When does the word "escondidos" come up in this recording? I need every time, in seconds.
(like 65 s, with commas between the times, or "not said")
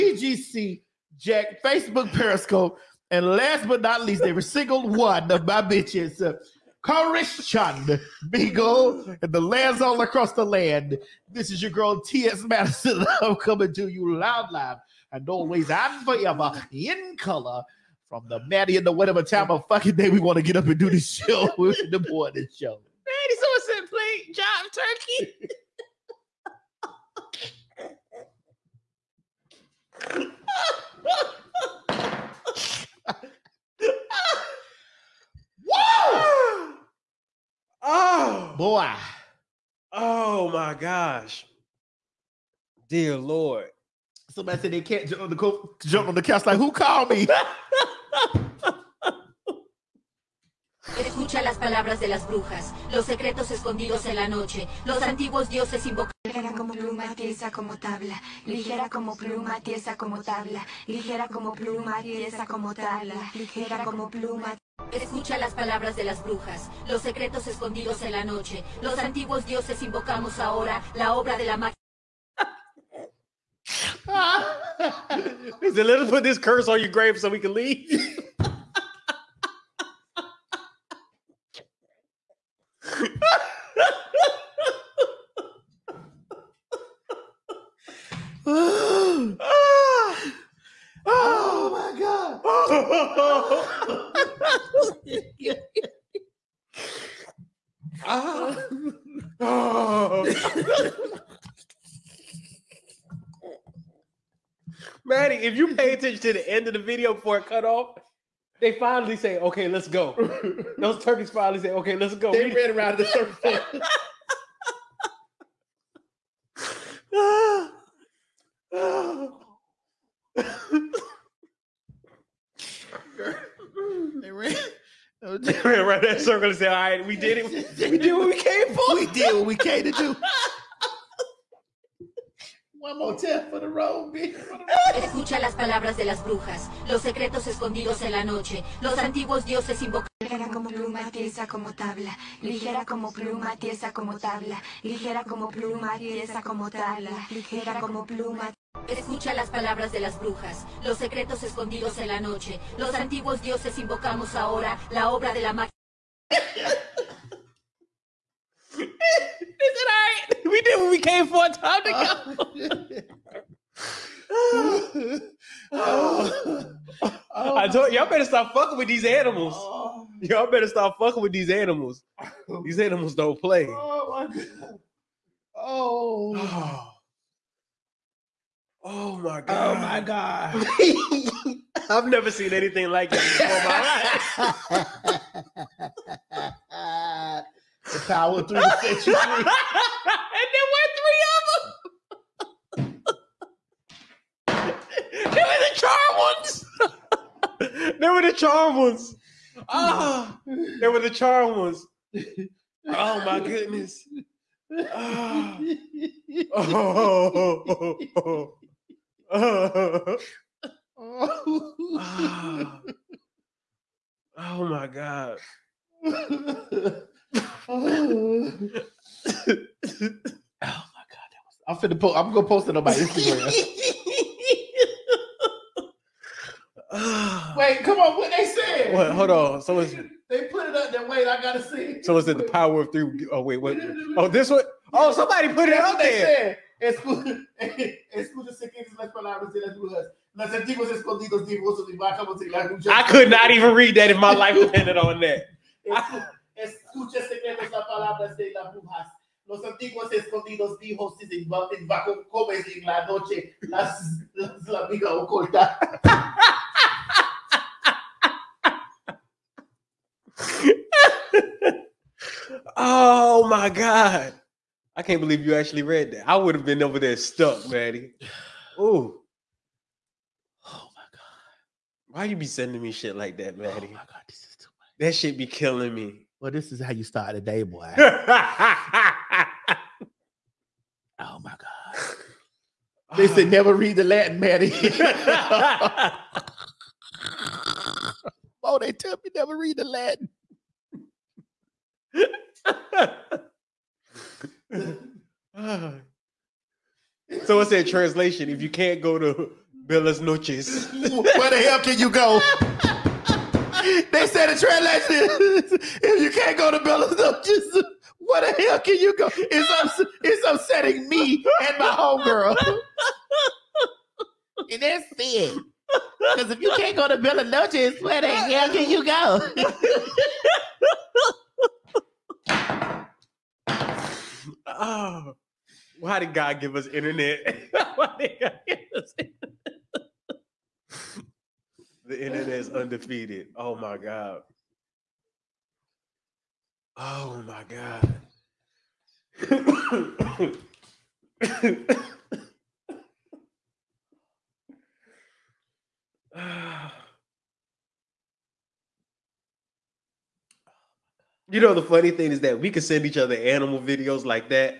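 53 s, 67 s, 137 s, 151 s, 250 s.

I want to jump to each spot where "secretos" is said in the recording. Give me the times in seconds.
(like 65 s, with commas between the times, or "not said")
53 s, 67 s, 137 s, 150 s.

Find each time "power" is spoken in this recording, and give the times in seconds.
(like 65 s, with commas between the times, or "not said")
188 s, 232 s.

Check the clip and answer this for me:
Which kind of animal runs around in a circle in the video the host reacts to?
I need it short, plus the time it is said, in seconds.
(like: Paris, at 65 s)
Turkeys, at 110 s.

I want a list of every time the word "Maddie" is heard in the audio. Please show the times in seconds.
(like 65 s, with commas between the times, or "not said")
18 s, 23 s, 267 s, 273 s, 284 s.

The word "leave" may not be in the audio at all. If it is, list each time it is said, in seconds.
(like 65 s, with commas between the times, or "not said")
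77 s.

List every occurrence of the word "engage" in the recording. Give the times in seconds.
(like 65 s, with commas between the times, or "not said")
not said.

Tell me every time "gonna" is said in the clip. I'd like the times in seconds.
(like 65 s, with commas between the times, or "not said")
222 s.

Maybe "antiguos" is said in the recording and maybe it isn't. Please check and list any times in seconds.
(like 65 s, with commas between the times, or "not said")
55 s, 68 s, 138 s, 152 s, 249 s.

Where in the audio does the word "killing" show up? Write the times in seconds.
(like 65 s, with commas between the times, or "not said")
275 s.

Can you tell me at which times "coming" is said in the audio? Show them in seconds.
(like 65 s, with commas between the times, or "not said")
13 s.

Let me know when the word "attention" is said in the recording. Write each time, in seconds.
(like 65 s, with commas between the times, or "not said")
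106 s.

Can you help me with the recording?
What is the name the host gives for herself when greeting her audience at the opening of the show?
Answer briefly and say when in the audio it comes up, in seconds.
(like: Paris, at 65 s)
T.S. Madison, at 12 s.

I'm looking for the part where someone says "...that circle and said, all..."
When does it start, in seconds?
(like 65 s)
126 s.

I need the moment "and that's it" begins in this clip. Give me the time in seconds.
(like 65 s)
314 s.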